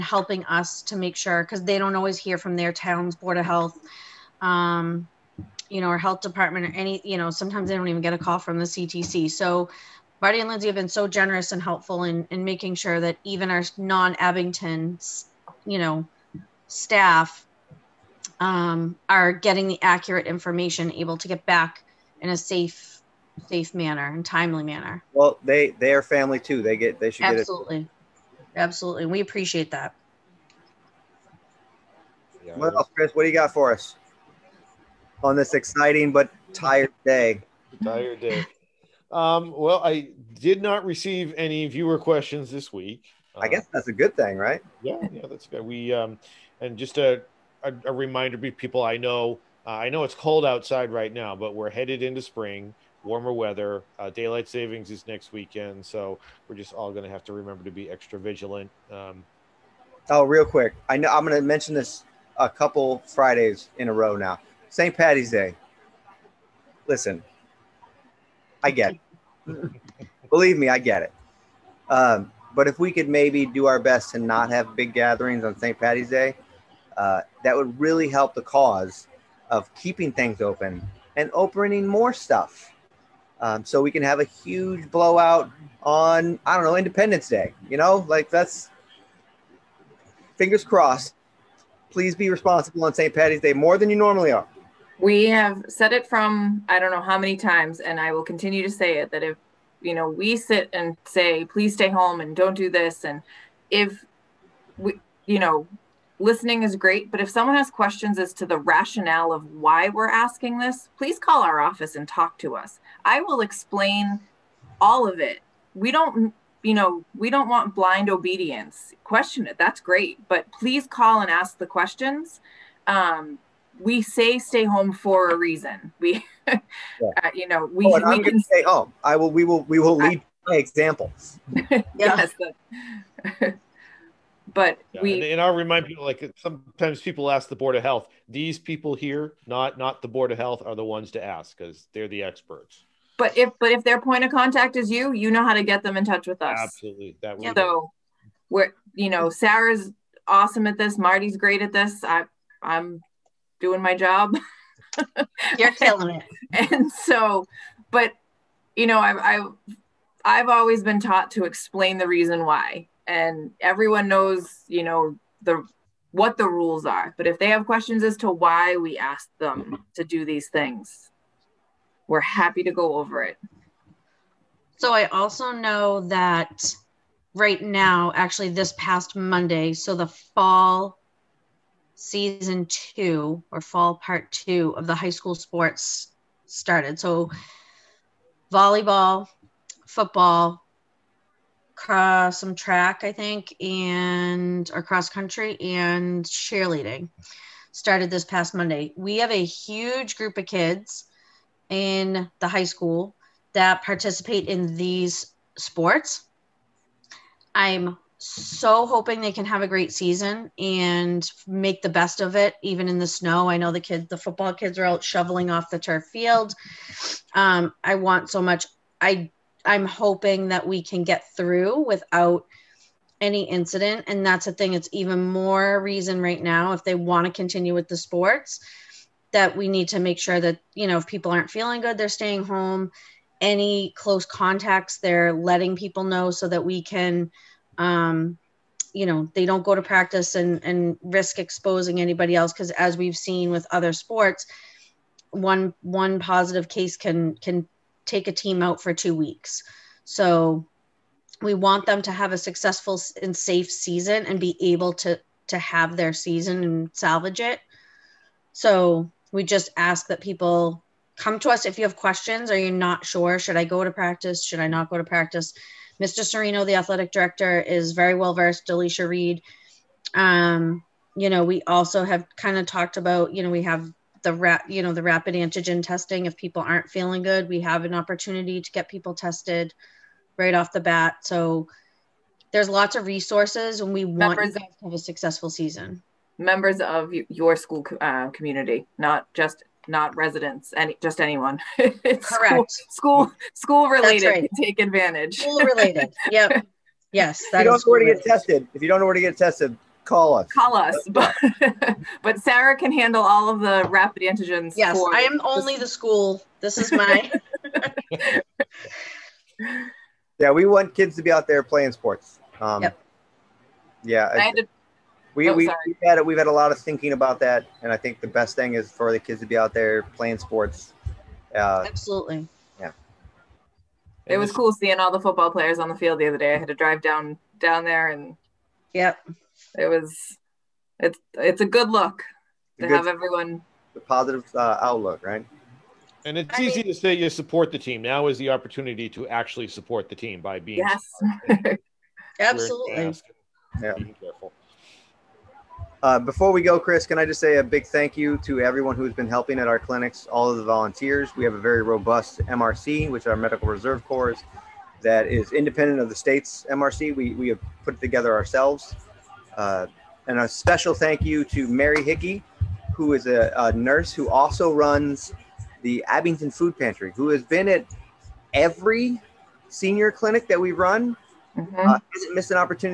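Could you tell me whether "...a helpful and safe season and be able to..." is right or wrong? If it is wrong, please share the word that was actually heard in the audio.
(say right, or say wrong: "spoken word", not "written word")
wrong: "successful", not "helpful".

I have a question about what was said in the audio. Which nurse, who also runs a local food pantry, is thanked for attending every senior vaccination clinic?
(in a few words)
Mary Hickey.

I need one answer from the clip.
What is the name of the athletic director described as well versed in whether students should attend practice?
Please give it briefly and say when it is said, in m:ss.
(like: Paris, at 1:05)
Mr. Serino, at 4:26.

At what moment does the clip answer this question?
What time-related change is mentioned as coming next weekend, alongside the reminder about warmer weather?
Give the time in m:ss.
0:54.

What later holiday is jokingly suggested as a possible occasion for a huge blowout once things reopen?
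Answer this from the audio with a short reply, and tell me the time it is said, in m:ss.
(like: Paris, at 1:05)
Independence Day, at 1:26.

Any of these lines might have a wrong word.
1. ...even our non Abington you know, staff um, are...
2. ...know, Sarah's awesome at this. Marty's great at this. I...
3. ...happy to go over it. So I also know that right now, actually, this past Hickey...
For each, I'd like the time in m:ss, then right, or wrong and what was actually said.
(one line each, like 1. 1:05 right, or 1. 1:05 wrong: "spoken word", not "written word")
1. 0:13 right
2. 2:29 right
3. 2:52 wrong: "Monday", not "Hickey".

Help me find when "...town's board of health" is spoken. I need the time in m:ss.
0:02.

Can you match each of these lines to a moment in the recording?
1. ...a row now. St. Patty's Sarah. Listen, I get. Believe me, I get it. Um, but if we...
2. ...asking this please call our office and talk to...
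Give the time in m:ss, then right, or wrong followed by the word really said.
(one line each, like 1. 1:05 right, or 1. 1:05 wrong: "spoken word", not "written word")
1. 1:03 wrong: "Day", not "Sarah"
2. 1:50 right.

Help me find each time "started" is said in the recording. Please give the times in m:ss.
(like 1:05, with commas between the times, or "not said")
3:06, 3:17.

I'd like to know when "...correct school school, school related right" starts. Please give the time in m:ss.
4:51.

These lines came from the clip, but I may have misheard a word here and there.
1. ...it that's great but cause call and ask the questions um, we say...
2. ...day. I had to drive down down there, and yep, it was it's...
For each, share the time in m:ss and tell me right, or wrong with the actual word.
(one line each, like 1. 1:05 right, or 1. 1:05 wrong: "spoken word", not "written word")
1. 1:59 wrong: "please", not "cause"
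2. 5:26 right.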